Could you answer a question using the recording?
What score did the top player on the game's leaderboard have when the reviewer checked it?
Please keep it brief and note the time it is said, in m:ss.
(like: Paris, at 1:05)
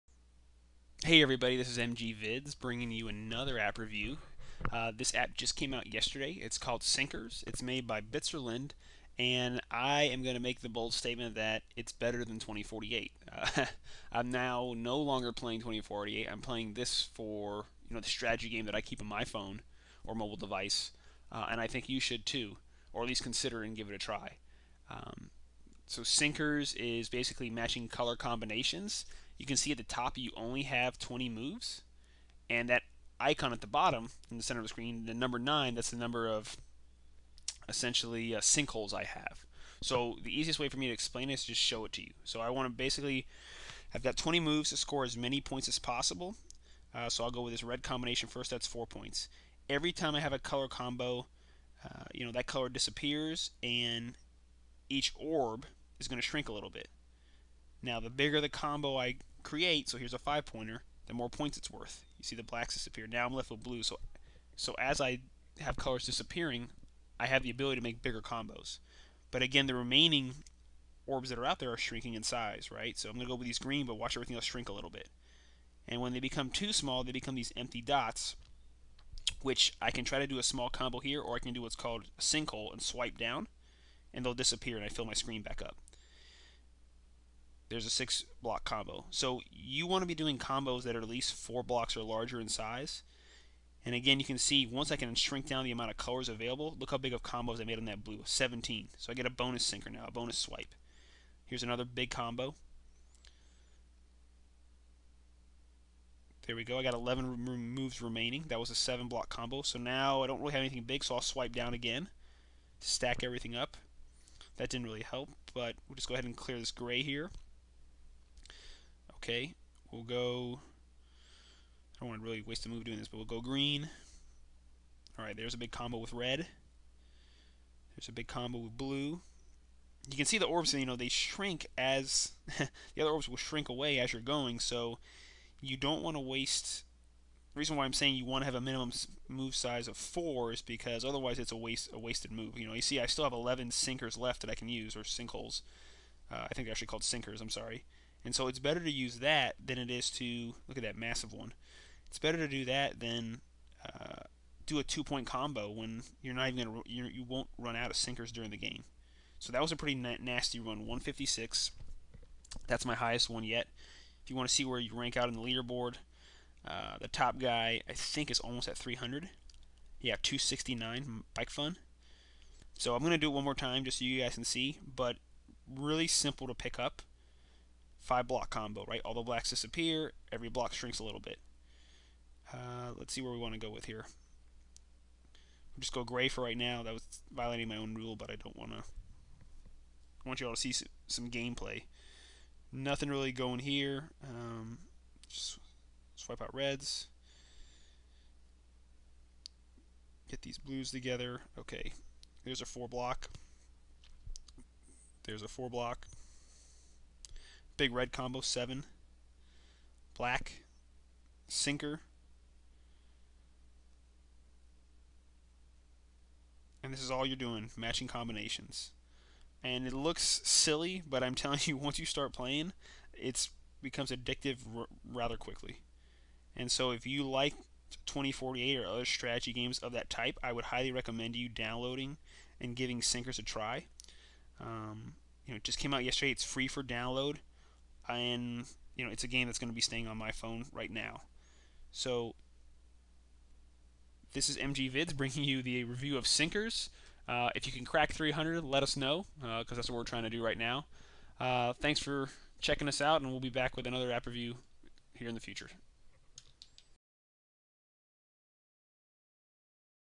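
269, at 2:50.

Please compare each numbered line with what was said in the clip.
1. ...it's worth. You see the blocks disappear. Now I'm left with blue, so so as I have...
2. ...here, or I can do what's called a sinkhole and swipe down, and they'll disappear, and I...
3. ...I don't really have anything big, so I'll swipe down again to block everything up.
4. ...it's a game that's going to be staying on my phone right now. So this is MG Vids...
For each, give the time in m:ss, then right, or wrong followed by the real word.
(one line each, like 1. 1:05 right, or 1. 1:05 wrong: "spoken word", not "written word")
1. 1:01 wrong: "blacks", not "blocks"
2. 1:20 right
3. 1:50 wrong: "stack", not "block"
4. 3:59 right.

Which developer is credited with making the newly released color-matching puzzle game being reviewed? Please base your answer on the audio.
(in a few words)
Bitzerland.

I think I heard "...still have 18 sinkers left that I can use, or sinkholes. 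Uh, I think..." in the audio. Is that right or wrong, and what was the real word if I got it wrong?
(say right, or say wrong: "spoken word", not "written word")
wrong: "11", not "18".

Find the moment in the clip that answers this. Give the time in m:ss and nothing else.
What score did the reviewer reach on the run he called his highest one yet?
2:40.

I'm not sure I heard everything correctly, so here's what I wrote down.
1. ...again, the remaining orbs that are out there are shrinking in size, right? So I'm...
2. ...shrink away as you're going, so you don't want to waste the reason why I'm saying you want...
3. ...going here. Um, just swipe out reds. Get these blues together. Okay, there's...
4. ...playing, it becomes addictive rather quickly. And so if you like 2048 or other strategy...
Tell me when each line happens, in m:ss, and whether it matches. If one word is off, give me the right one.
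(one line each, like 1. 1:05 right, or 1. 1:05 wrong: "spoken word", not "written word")
1. 1:09 right
2. 2:13 right
3. 3:13 right
4. 3:42 right.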